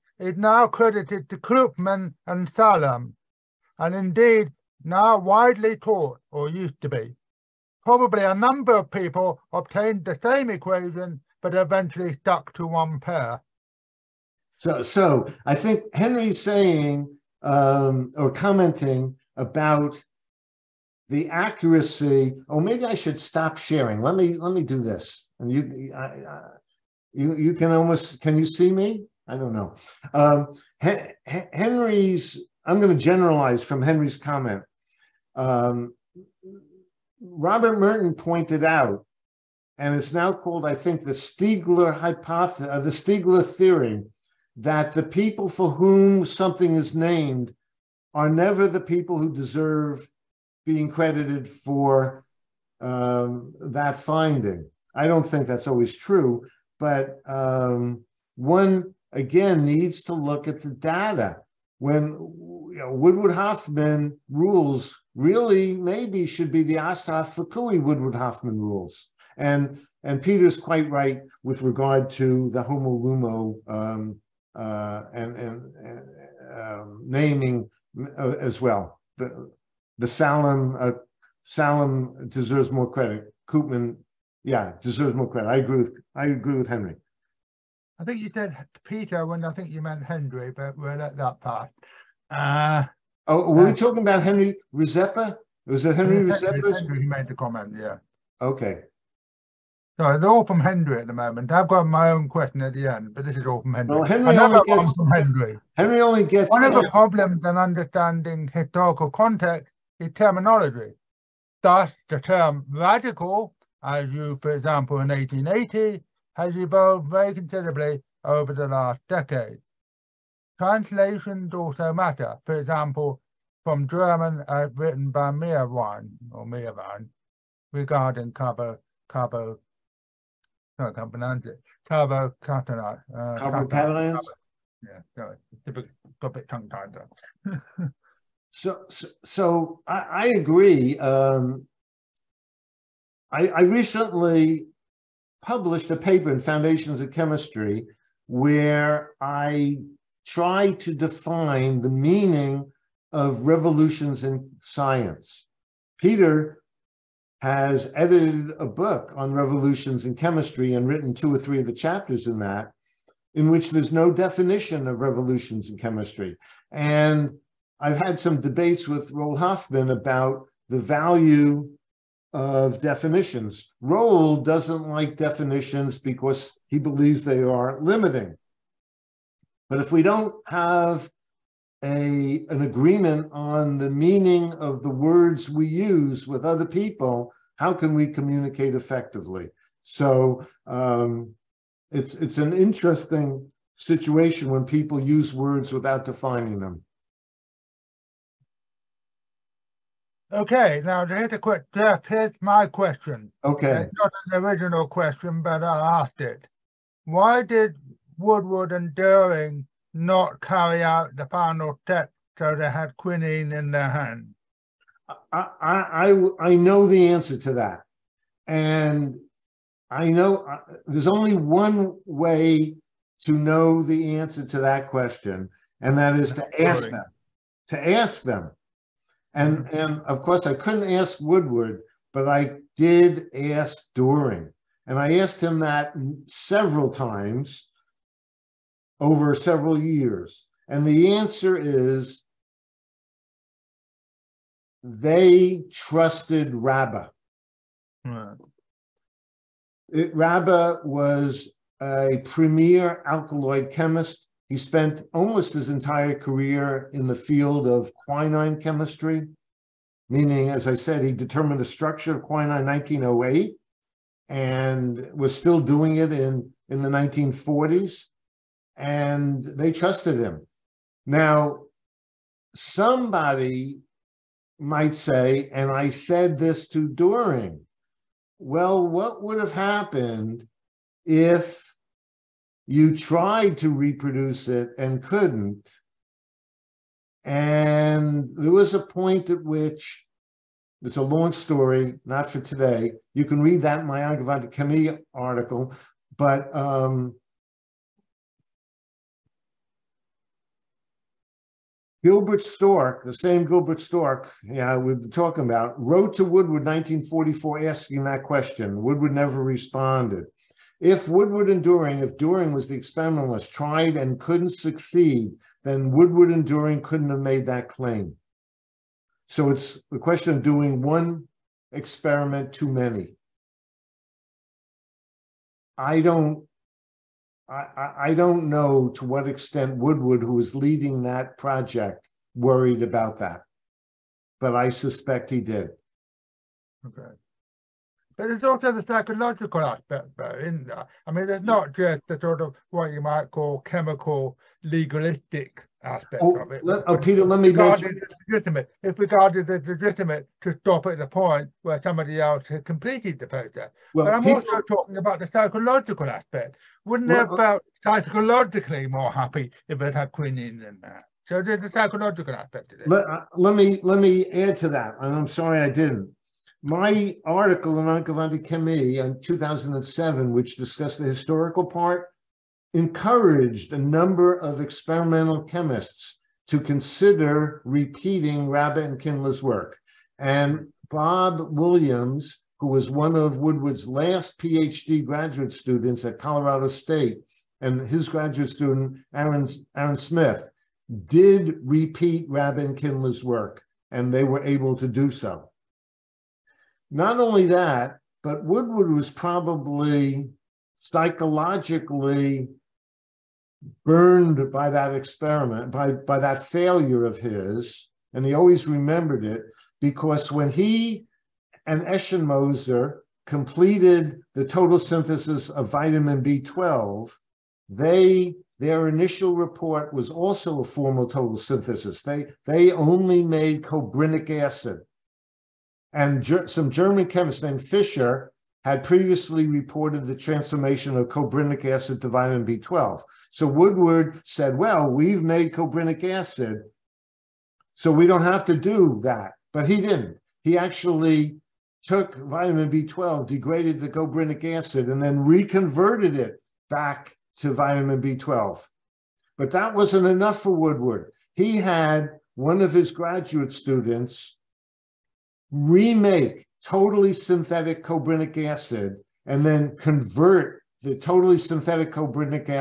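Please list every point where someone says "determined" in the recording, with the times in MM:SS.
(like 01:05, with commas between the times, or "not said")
04:21.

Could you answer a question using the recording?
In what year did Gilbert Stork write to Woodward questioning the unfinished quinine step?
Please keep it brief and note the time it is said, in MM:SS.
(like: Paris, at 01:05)
1944, at 05:06.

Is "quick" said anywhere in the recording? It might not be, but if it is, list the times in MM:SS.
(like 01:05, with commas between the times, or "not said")
03:21.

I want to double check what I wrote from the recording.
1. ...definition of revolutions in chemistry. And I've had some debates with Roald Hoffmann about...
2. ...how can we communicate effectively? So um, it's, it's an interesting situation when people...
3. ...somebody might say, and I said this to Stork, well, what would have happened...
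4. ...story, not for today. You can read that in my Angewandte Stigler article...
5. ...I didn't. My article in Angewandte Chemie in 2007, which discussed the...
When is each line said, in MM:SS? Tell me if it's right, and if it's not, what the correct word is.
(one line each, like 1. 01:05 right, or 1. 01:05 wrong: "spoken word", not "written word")
1. 02:44 right
2. 03:07 right
3. 04:32 wrong: "Doering", not "Stork"
4. 04:51 wrong: "Chemie", not "Stigler"
5. 06:05 right.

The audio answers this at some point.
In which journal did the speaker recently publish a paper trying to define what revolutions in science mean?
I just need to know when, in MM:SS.
02:26.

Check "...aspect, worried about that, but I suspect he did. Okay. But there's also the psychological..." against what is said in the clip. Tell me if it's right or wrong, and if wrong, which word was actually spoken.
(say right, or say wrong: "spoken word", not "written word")
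wrong: "project", not "aspect".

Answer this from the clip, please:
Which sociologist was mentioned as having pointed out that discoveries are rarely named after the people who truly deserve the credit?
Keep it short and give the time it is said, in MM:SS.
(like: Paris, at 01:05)
Robert Merton, at 00:37.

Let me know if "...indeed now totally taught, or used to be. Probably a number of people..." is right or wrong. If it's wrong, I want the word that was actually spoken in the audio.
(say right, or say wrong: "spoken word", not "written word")
wrong: "widely", not "totally".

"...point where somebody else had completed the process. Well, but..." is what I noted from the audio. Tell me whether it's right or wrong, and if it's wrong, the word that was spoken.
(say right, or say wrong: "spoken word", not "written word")
right.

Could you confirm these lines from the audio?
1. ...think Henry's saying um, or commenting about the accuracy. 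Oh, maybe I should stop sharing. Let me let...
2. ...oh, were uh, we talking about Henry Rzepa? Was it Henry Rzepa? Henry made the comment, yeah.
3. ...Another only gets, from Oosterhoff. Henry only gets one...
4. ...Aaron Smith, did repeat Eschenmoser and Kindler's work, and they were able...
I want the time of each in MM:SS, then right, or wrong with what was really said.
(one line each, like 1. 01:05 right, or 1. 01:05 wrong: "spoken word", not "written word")
1. 00:15 right
2. 01:33 right
3. 01:44 wrong: "Henry", not "Oosterhoff"
4. 06:29 wrong: "Rabe", not "Eschenmoser".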